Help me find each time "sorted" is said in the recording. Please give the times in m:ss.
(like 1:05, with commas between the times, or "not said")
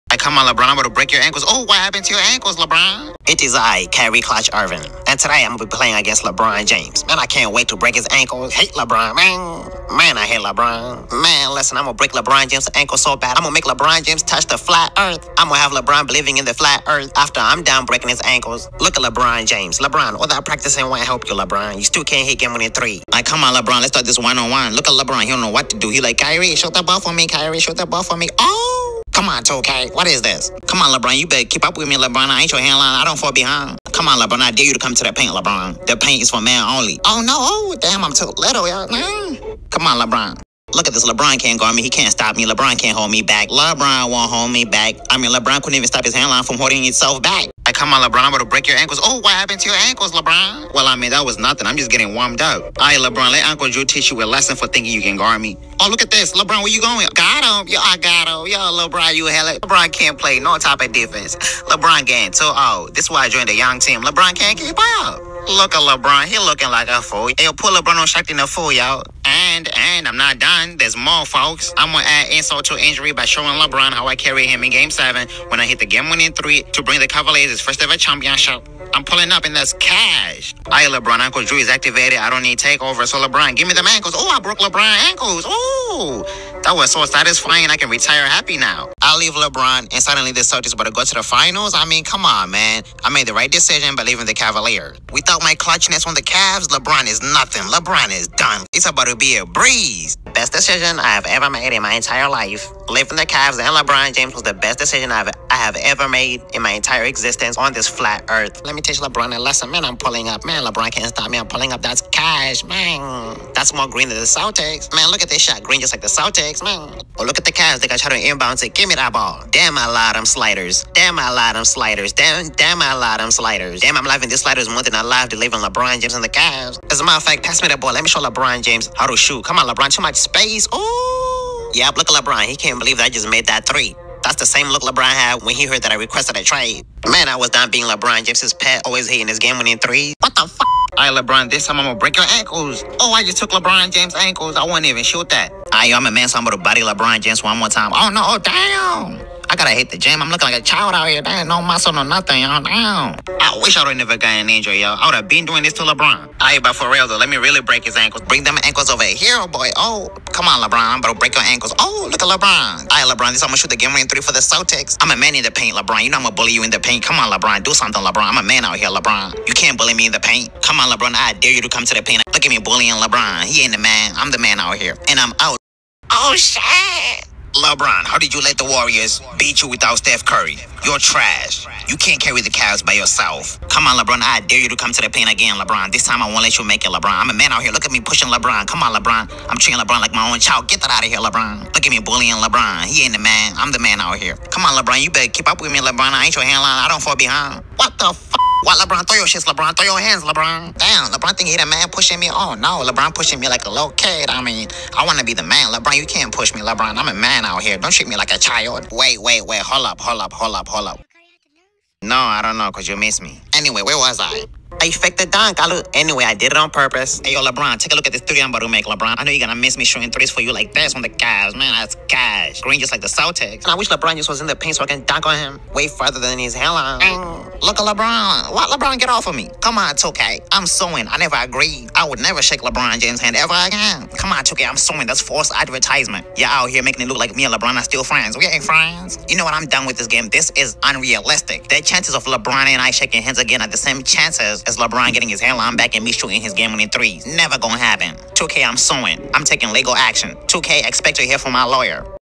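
not said.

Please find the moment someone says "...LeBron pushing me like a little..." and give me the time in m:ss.
3:22.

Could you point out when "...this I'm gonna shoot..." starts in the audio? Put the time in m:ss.
2:43.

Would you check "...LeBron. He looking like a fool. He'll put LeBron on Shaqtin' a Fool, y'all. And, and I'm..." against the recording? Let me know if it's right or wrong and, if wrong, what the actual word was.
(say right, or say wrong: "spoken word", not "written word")
right.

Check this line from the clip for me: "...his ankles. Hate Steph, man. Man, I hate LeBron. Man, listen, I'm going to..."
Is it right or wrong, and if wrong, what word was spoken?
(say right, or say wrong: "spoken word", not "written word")
wrong: "LeBron", not "Steph".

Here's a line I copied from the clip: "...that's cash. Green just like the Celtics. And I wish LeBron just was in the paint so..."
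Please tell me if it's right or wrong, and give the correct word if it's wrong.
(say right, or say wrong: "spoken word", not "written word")
right.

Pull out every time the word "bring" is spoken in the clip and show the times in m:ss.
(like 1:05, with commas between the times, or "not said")
1:16, 2:38.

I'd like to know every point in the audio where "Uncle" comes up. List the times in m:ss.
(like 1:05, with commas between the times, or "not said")
0:53, 1:21.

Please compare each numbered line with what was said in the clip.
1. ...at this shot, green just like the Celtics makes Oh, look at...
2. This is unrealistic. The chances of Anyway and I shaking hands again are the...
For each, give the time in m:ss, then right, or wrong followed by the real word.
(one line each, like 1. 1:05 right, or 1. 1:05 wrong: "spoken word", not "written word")
1. 1:55 right
2. 4:00 wrong: "LeBron", not "Anyway".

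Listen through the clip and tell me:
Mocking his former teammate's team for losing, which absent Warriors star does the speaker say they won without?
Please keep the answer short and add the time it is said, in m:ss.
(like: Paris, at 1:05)
Steph Curry, at 2:59.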